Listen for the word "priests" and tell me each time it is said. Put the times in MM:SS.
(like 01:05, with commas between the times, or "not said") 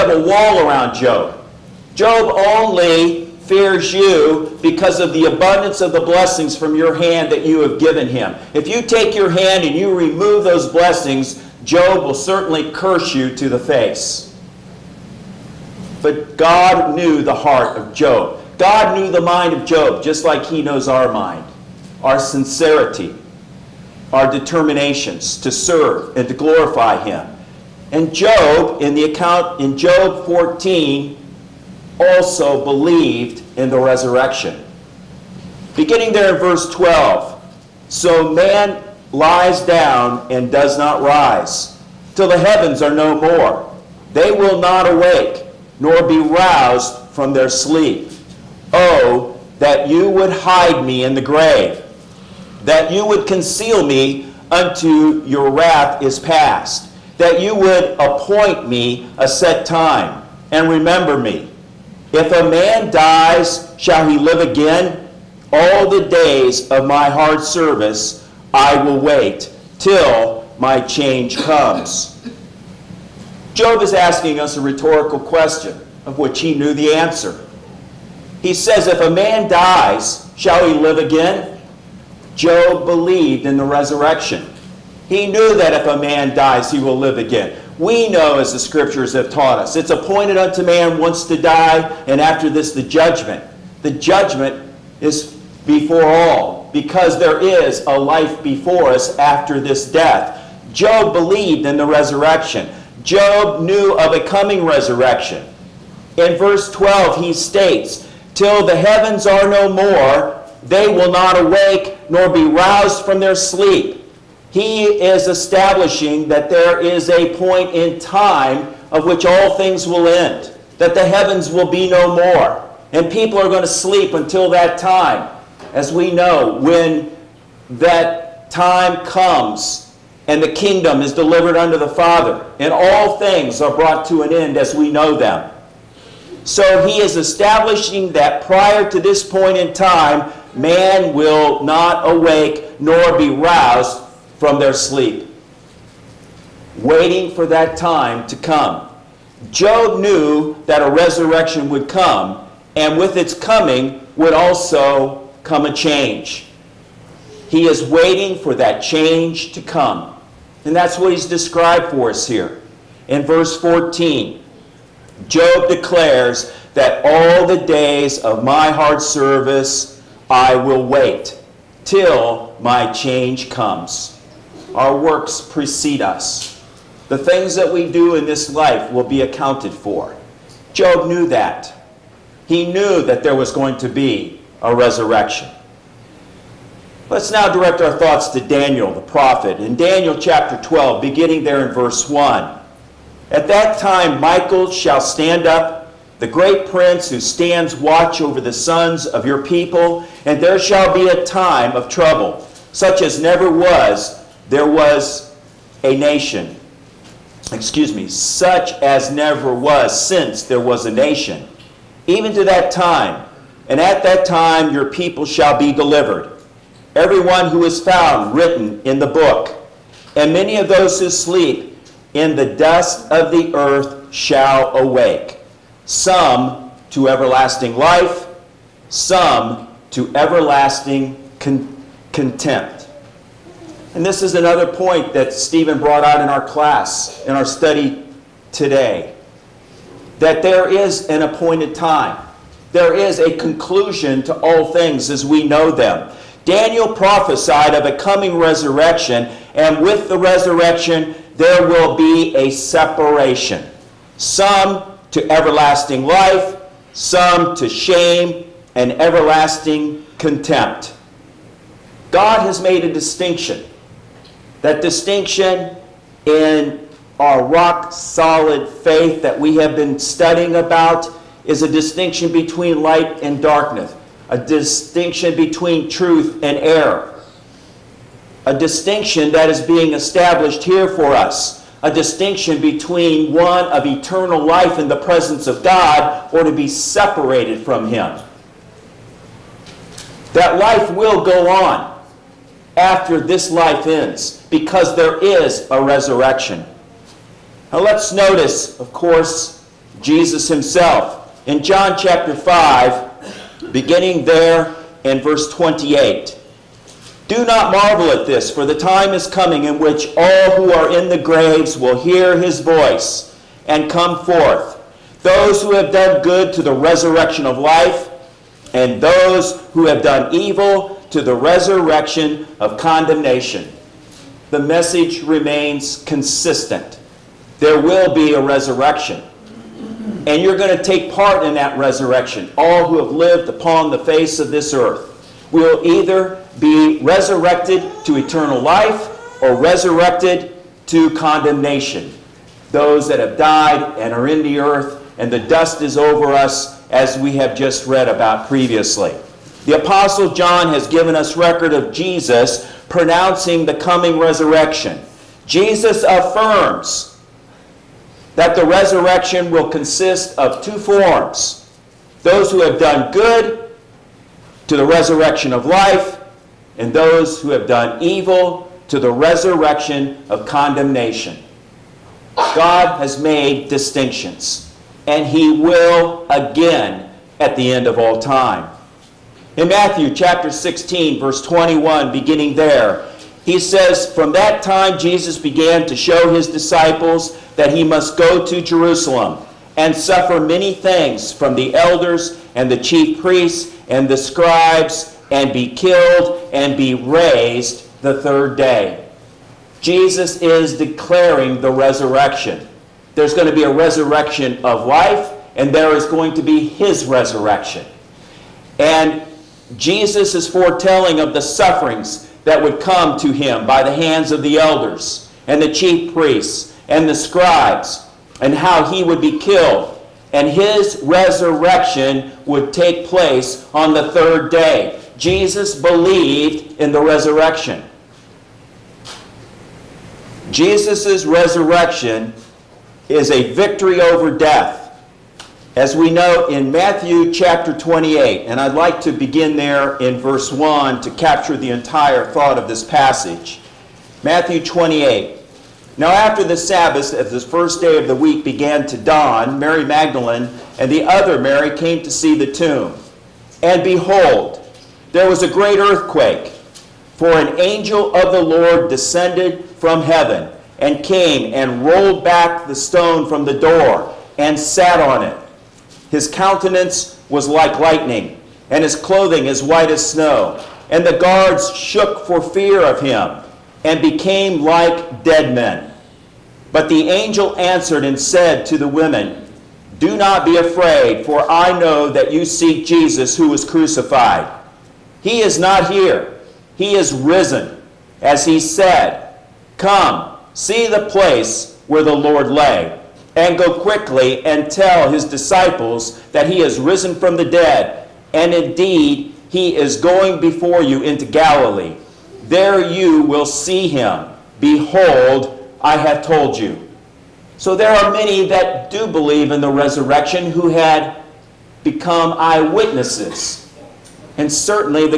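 06:33, 06:56.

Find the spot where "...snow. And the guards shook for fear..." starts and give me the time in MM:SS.
07:50.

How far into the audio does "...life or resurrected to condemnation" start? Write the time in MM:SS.
05:38.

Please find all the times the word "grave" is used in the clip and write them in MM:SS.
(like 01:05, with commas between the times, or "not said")
00:51, 05:11.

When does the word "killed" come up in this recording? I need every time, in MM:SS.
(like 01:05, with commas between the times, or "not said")
06:35, 06:59.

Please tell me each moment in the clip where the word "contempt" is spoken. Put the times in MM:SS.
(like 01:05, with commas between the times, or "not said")
03:52, 04:20.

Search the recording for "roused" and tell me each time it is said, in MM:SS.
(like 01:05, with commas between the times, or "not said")
00:46, 01:52, 02:23.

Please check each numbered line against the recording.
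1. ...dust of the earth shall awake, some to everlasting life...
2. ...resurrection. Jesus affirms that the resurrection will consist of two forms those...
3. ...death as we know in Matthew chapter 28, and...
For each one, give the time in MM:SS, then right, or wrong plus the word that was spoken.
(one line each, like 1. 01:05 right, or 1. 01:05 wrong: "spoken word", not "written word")
1. 03:42 right
2. 05:54 right
3. 07:14 right.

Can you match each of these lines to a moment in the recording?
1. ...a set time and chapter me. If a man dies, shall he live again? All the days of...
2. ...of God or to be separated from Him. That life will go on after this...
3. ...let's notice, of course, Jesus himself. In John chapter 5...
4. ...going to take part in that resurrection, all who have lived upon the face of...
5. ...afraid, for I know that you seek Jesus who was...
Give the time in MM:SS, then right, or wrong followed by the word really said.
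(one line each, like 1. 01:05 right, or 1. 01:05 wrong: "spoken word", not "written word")
1. 00:59 wrong: "remember", not "chapter"
2. 04:45 right
3. 04:57 right
4. 05:30 right
5. 08:00 right.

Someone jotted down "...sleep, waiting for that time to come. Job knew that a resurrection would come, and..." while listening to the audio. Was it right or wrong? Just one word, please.
right.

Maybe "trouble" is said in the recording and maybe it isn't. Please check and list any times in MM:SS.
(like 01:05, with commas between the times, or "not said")
03:21.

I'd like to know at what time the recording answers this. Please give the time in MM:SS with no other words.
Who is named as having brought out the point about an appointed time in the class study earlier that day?
03:55.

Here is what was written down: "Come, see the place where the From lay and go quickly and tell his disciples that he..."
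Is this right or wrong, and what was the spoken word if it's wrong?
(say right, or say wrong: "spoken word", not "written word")
wrong: "Lord", not "From".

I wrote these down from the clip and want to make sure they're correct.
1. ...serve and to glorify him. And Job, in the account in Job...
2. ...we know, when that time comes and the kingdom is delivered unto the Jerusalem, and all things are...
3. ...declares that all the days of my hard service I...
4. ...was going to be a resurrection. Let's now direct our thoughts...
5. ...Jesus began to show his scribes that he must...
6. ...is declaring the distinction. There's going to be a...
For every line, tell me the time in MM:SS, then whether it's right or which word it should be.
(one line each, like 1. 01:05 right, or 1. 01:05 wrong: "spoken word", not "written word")
1. 00:25 right
2. 02:05 wrong: "Father", not "Jerusalem"
3. 02:45 right
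4. 03:03 right
5. 06:24 wrong: "disciples", not "scribes"
6. 06:40 wrong: "resurrection", not "distinction".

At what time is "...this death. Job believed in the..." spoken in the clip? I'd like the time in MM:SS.
01:39.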